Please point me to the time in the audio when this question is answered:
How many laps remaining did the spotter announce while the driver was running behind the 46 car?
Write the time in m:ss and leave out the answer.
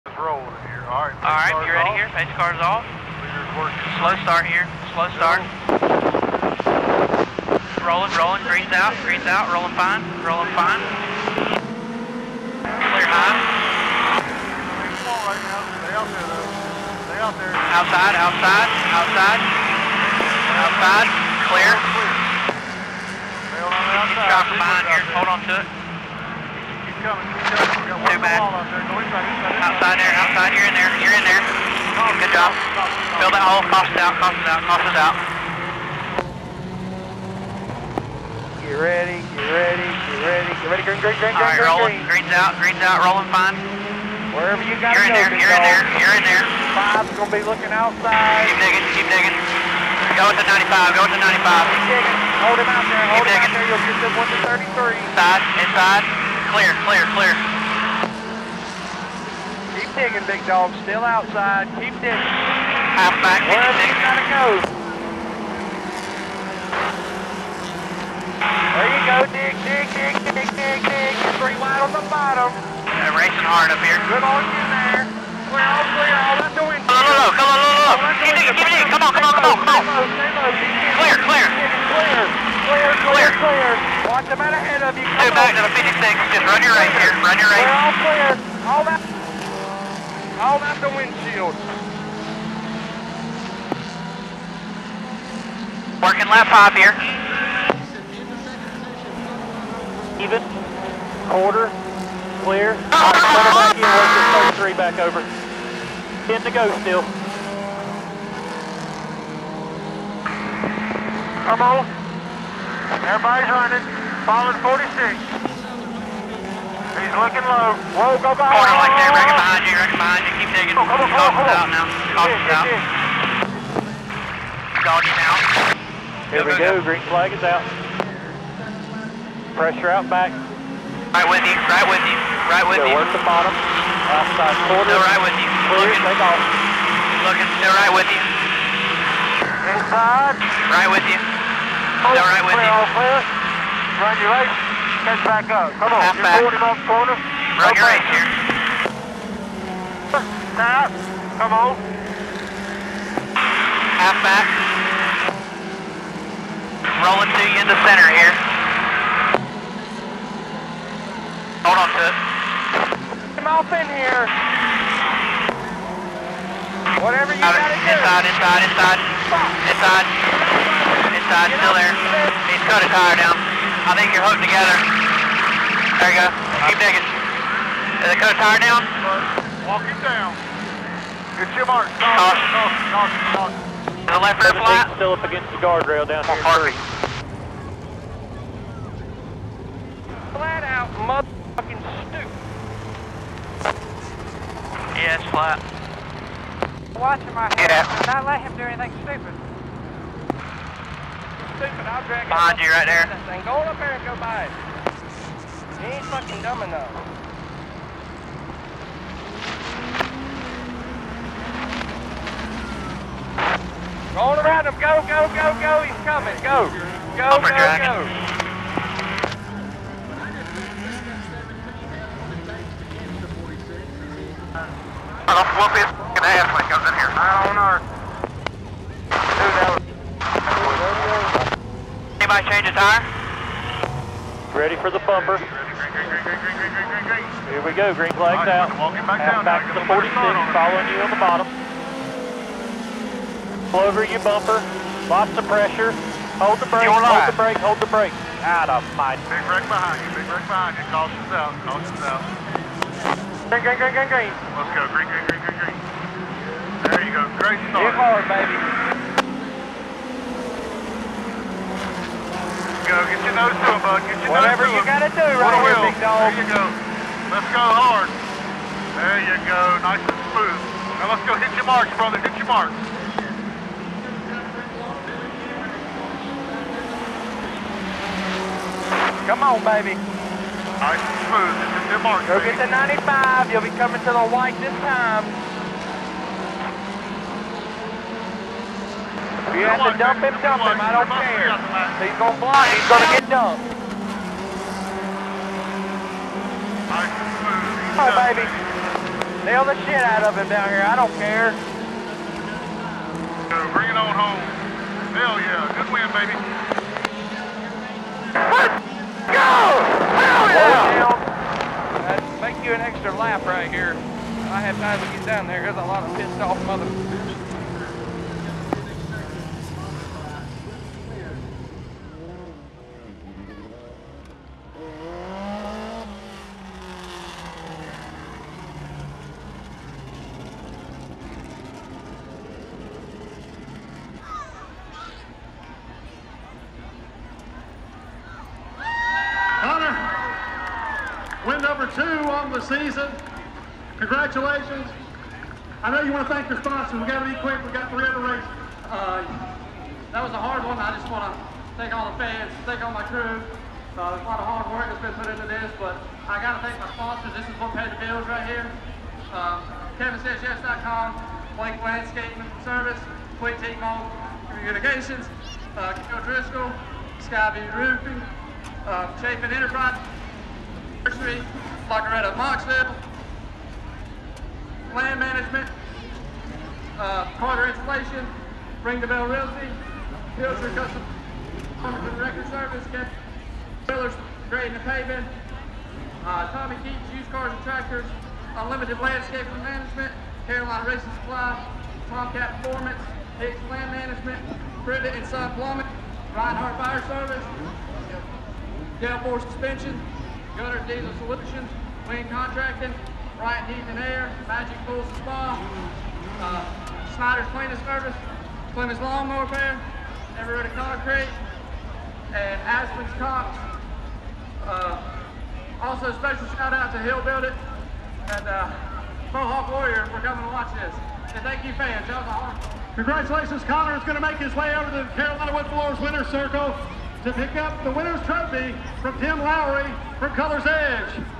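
1:46.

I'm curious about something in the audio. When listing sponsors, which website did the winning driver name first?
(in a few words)
KevinSaysYes.com.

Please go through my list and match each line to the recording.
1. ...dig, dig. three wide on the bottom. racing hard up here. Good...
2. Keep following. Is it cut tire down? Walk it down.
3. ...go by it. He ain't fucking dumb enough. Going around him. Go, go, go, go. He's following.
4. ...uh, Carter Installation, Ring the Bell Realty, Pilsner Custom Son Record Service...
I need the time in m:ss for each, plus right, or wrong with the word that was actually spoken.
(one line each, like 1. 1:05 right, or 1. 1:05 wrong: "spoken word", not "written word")
1. 1:10 right
2. 2:56 wrong: "digging", not "following"
3. 3:24 wrong: "coming", not "following"
4. 6:16 wrong: "Cumberland", not "Son".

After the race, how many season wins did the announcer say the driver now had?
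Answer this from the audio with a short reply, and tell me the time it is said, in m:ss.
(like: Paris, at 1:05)
2, at 5:41.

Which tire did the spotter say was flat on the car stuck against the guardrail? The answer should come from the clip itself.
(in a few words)
Left rear.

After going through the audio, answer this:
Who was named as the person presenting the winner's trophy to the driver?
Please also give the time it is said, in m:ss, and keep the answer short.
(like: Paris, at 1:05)
Tim Lowry, at 7:09.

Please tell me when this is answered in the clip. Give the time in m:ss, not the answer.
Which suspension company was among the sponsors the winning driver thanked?
6:39.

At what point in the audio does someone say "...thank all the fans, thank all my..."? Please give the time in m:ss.
5:51.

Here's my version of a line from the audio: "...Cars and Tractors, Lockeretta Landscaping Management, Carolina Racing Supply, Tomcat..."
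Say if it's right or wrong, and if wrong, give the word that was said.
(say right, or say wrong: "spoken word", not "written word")
wrong: "Unlimited", not "Lockeretta".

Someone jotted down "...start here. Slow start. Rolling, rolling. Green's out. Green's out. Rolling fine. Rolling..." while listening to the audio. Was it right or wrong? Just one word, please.
right.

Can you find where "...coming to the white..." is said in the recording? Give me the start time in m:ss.
4:43.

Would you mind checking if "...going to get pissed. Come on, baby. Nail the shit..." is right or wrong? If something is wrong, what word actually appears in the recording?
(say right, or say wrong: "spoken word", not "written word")
wrong: "dumped", not "pissed".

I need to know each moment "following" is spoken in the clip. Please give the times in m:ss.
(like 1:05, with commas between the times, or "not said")
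1:54, 4:00.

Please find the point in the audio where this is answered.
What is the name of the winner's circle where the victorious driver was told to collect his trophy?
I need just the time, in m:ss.
7:05.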